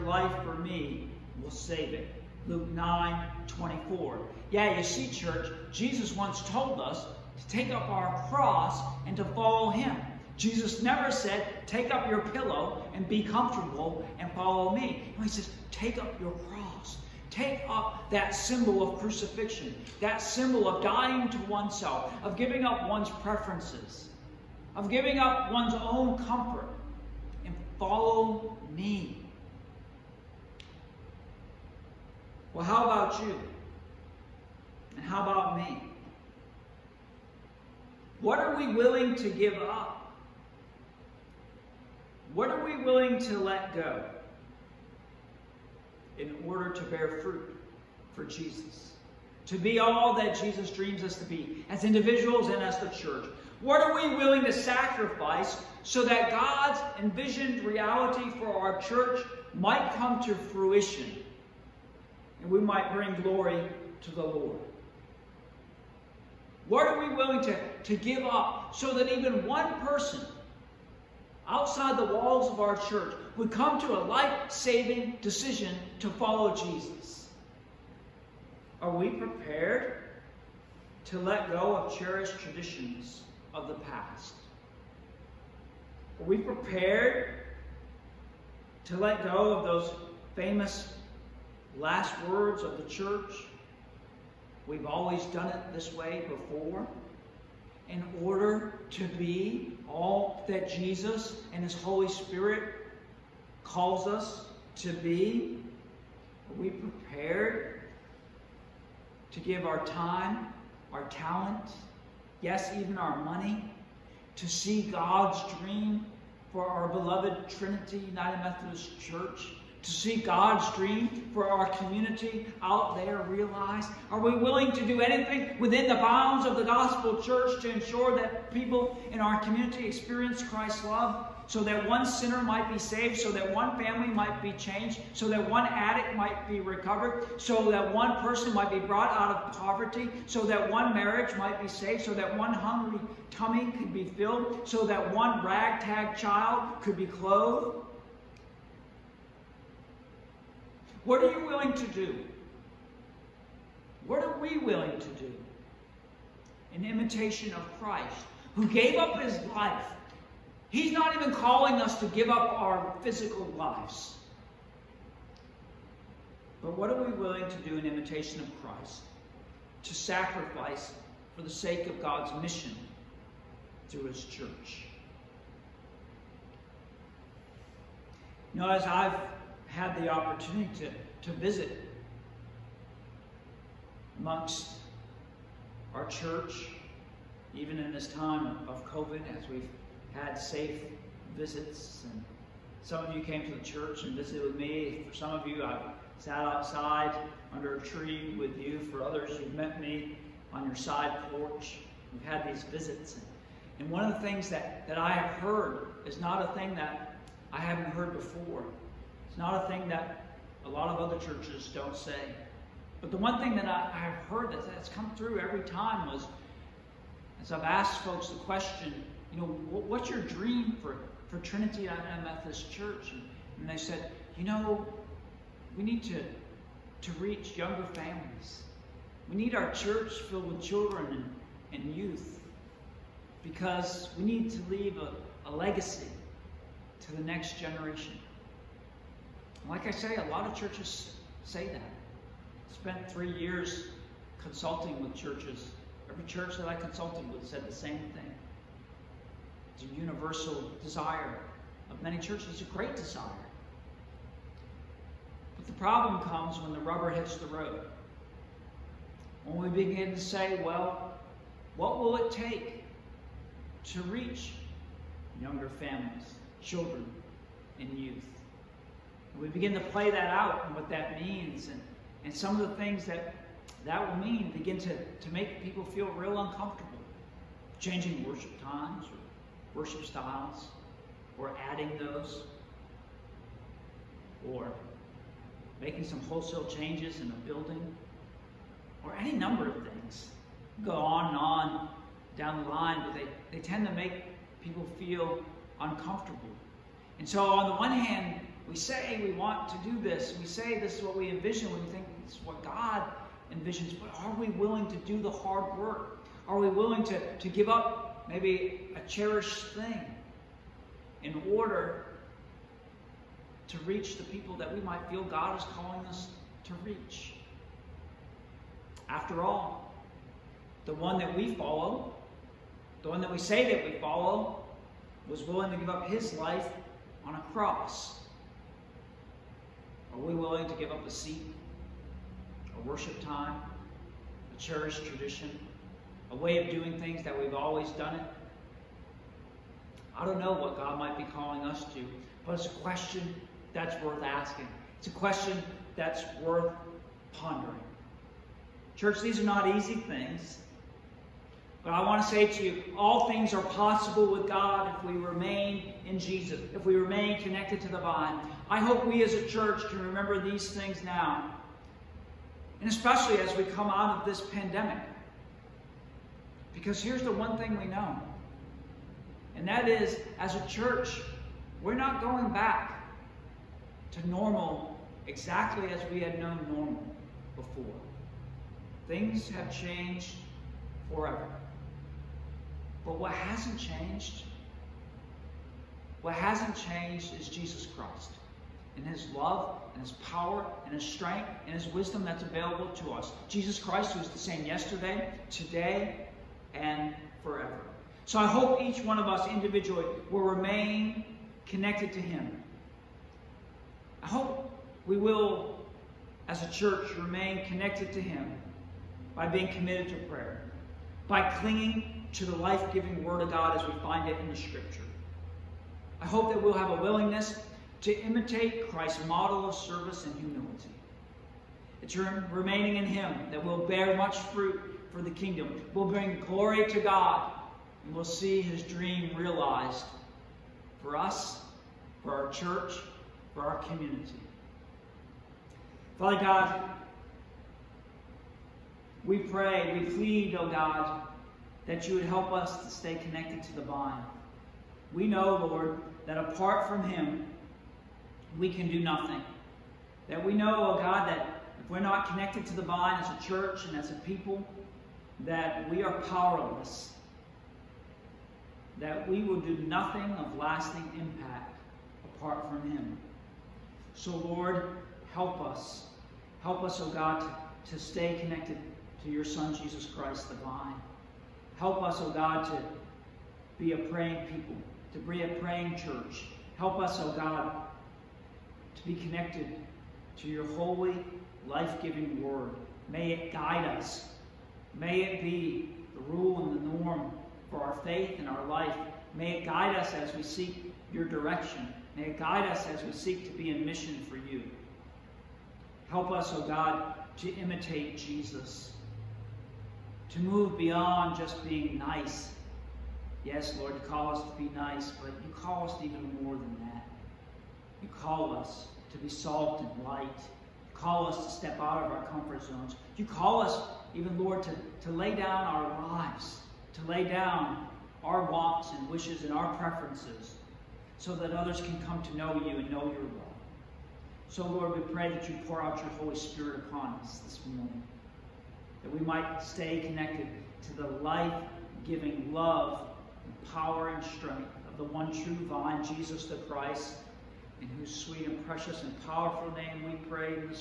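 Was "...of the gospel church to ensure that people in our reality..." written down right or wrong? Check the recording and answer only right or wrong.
wrong.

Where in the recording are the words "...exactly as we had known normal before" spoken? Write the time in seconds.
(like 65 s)
375 s.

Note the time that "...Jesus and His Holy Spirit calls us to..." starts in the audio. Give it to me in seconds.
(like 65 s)
100 s.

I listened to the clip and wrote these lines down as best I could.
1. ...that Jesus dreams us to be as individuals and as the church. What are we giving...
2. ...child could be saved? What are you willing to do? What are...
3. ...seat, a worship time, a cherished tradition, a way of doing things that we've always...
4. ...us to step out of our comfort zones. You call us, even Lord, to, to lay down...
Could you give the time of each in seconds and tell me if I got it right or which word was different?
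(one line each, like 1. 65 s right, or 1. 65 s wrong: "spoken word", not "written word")
1. 50 s wrong: "willing", not "giving"
2. 146 s wrong: "clothed", not "saved"
3. 331 s right
4. 511 s right.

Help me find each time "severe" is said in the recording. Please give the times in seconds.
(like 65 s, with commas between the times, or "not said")
not said.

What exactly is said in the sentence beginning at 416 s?
I hope that we'll have a willingness to imitate Christ's model of service and humility.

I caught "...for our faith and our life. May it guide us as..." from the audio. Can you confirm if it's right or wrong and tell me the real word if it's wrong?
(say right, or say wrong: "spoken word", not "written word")
right.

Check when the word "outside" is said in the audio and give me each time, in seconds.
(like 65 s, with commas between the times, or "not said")
71 s, 196 s.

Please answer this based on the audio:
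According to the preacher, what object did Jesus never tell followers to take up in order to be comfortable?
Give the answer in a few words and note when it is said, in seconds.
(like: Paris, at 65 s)
pillow, at 12 s.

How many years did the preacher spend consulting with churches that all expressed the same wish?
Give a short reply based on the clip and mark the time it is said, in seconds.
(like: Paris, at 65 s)
3, at 243 s.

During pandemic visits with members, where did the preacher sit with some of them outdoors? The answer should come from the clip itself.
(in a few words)
under a tree.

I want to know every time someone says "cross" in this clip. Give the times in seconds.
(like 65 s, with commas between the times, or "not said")
8 s, 16 s, 327 s.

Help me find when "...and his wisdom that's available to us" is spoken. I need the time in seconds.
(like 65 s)
391 s.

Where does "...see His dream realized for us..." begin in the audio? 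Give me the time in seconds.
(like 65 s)
428 s.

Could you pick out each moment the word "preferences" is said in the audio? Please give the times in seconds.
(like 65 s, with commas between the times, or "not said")
23 s, 519 s.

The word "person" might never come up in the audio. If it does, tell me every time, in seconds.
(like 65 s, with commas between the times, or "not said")
69 s, 138 s.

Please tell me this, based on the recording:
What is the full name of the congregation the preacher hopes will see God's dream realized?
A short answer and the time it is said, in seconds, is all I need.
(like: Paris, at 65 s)
Trinity United Methodist Church, at 117 s.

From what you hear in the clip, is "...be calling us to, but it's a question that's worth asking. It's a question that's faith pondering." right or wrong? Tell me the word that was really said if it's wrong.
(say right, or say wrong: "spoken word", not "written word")
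wrong: "worth", not "faith".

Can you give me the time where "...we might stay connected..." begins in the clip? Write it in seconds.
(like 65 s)
529 s.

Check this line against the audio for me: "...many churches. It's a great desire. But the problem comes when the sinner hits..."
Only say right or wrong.
wrong.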